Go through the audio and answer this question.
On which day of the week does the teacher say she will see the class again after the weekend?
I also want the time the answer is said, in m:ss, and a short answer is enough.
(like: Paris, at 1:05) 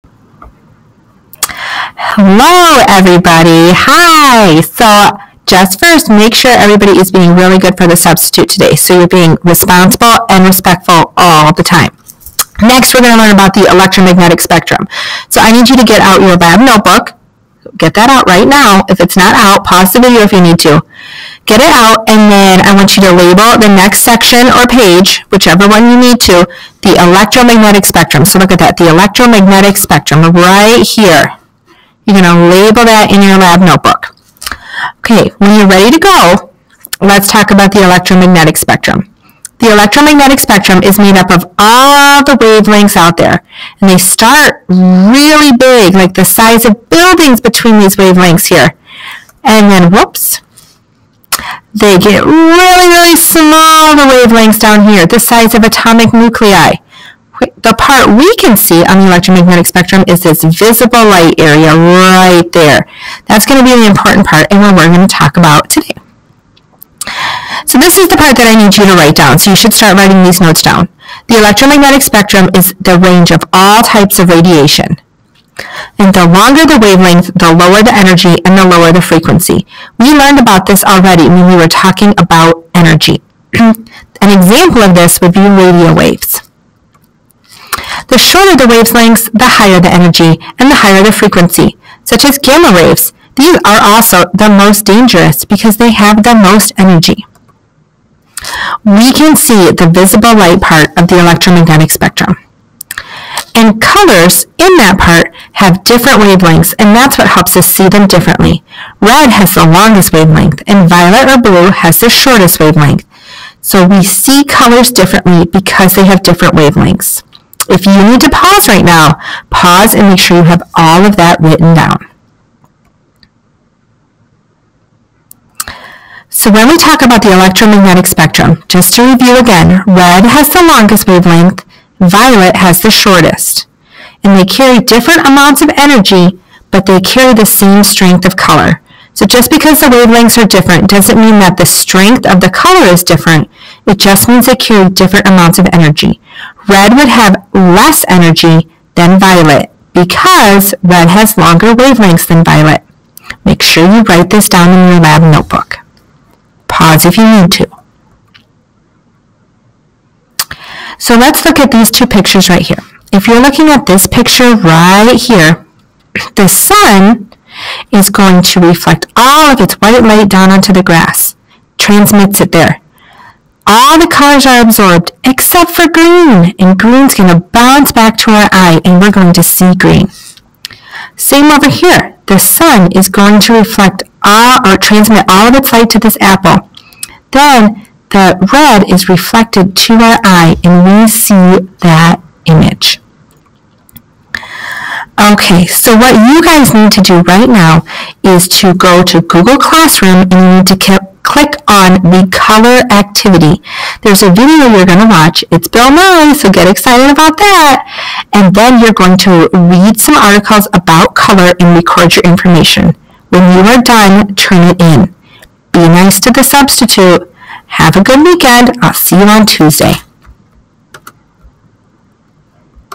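Tuesday, at 3:39.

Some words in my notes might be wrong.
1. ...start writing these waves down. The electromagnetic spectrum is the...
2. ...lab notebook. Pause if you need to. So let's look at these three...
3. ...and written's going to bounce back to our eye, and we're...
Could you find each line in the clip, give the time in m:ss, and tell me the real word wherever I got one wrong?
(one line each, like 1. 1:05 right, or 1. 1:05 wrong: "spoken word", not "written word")
1. 1:09 wrong: "notes", not "waves"
2. 2:35 wrong: "two", not "three"
3. 2:56 wrong: "green", not "written".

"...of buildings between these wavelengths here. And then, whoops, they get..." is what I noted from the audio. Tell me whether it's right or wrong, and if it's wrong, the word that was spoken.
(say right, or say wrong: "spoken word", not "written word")
right.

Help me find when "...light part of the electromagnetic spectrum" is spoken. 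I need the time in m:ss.
1:40.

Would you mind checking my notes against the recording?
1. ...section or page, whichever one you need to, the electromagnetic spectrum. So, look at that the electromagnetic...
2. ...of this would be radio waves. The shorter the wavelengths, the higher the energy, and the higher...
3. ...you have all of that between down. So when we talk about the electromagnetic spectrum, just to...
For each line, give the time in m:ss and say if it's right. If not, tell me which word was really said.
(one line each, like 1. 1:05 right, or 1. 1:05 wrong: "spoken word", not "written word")
1. 0:24 right
2. 1:24 right
3. 2:00 wrong: "written", not "between".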